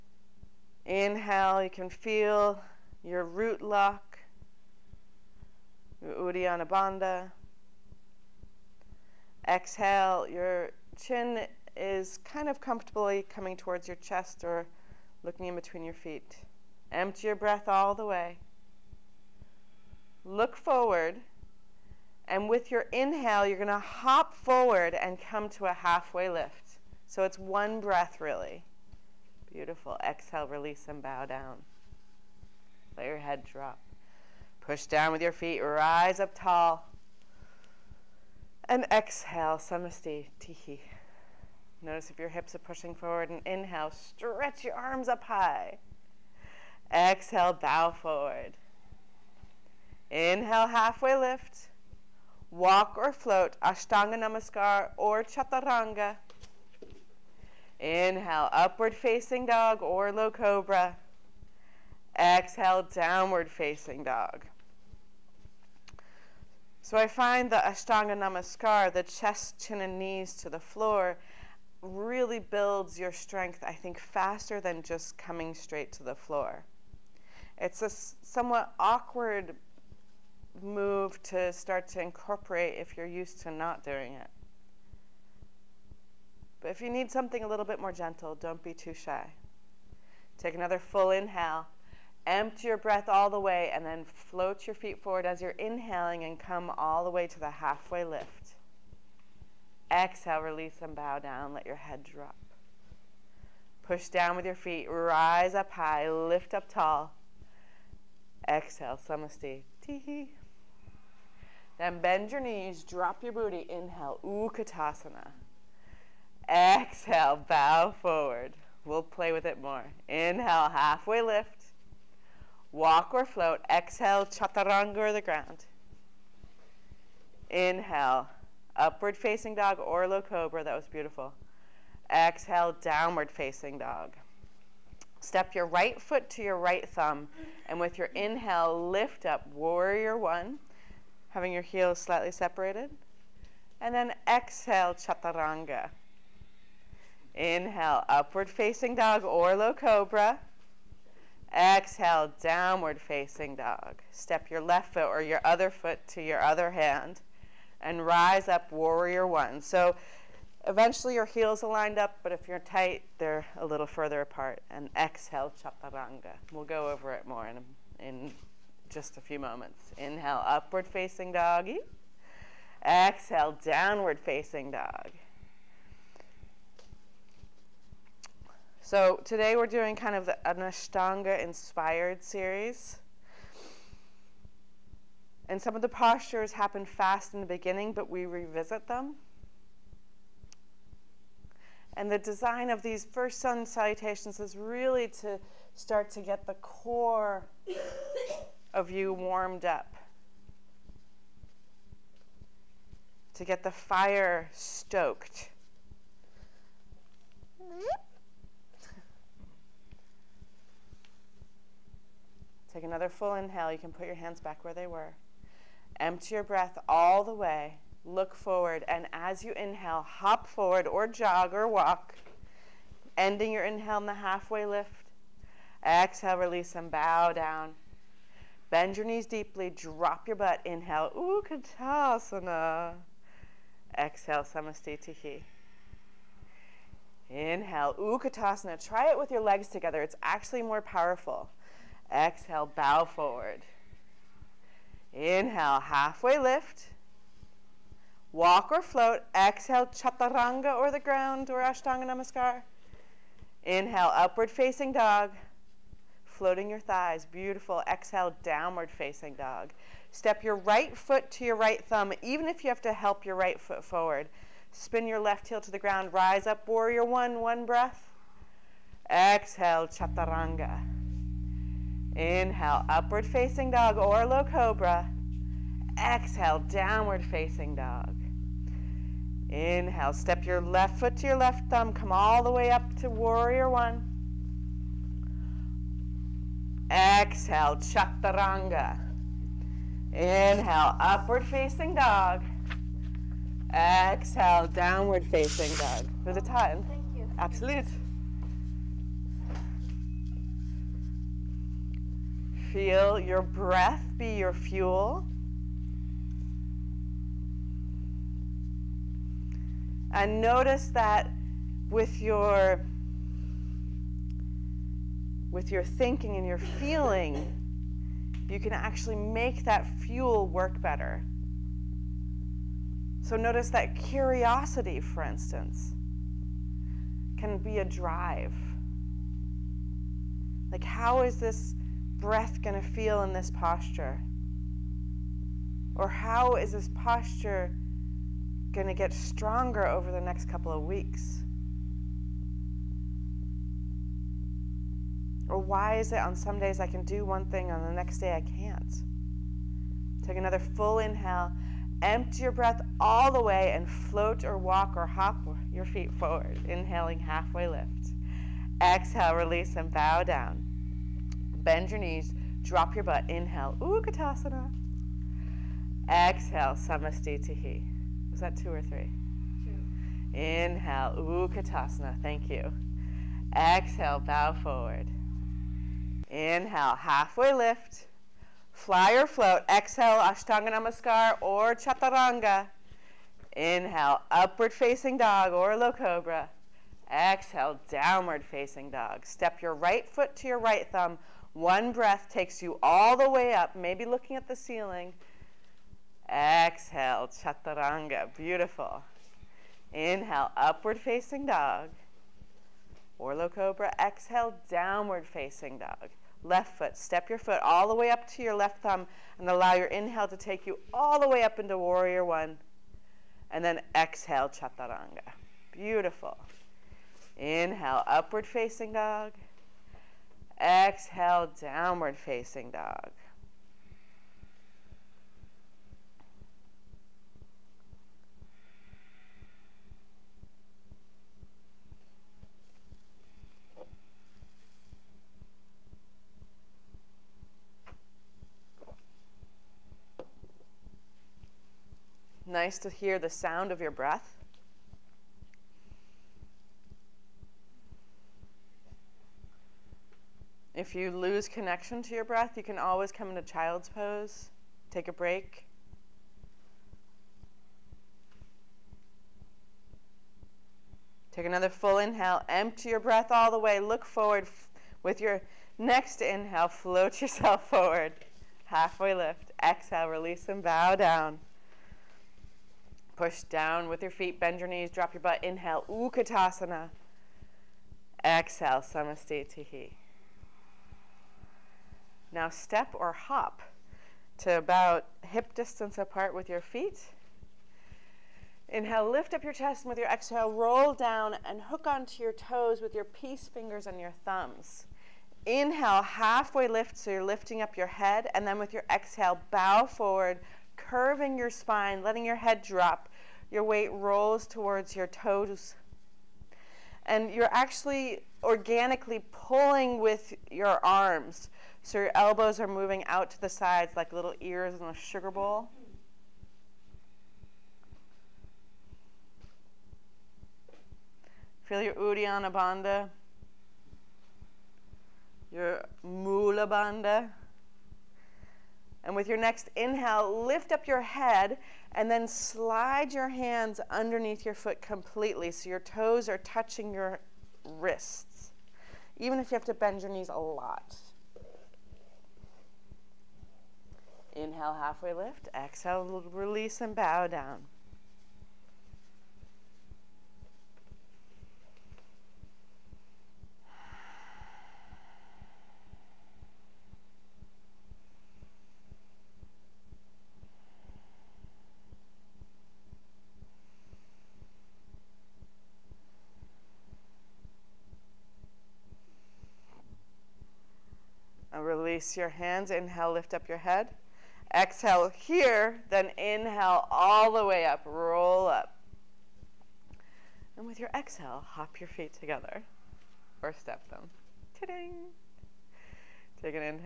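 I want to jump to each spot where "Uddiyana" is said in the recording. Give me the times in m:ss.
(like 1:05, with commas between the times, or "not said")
0:06, 8:41.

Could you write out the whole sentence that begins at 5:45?
Or why is it on some days I can do one thing, on the next day I can't?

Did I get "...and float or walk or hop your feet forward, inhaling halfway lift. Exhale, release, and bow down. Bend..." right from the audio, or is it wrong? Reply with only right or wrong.
right.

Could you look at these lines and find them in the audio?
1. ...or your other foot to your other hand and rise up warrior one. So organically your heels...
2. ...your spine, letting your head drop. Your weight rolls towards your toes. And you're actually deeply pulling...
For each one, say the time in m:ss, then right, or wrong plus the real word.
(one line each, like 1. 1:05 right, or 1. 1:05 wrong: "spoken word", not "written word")
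1. 2:35 wrong: "eventually", not "organically"
2. 8:21 wrong: "organically", not "deeply".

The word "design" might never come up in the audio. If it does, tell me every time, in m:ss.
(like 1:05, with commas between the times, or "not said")
3:12.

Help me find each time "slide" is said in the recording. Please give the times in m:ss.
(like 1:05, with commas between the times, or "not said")
8:52.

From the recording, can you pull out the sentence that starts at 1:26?
But if you need something a little bit more gentle, don't be too shy.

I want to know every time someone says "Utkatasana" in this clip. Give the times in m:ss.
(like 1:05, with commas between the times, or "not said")
1:54, 3:51, 3:57, 6:03, 6:11, 7:55.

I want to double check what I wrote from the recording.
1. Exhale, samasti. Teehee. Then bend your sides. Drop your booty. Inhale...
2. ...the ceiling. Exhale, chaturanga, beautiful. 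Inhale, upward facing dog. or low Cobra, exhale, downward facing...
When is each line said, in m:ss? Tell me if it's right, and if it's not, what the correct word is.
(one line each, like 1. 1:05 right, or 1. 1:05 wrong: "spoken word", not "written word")
1. 1:48 wrong: "knees", not "sides"
2. 6:34 right.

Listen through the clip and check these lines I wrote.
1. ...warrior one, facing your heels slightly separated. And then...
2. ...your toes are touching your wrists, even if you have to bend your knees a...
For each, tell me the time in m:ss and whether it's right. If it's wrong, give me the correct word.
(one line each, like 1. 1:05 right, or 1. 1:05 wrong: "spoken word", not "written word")
1. 2:19 wrong: "having", not "facing"
2. 8:55 right.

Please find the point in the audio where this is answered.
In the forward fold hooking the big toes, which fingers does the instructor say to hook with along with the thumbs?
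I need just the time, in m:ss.
8:13.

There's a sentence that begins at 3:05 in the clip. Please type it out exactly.
And some of the postures happen fast in the beginning, but we revisit them.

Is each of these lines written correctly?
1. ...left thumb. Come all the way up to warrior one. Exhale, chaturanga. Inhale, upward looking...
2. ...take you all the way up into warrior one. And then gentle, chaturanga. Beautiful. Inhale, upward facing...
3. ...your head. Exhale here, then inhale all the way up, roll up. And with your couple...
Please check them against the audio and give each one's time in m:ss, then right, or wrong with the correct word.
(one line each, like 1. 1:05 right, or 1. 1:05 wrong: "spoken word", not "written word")
1. 4:41 wrong: "facing", not "looking"
2. 6:50 wrong: "exhale", not "gentle"
3. 9:33 wrong: "exhale", not "couple".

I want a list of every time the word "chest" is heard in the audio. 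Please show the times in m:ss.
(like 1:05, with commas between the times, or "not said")
0:13, 1:09, 8:09.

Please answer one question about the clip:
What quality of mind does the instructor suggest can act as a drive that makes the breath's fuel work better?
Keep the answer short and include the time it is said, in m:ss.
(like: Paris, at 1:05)
Curiosity, at 5:23.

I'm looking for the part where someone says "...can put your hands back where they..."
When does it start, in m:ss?
3:33.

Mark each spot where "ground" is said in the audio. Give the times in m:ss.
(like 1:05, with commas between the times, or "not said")
2:05, 4:10, 4:25.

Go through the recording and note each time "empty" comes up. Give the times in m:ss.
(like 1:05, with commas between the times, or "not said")
0:16, 1:32, 3:35, 5:52, 7:42.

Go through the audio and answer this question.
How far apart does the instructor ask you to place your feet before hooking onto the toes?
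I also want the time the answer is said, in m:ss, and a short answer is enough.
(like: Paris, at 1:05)
Hip distance, at 8:05.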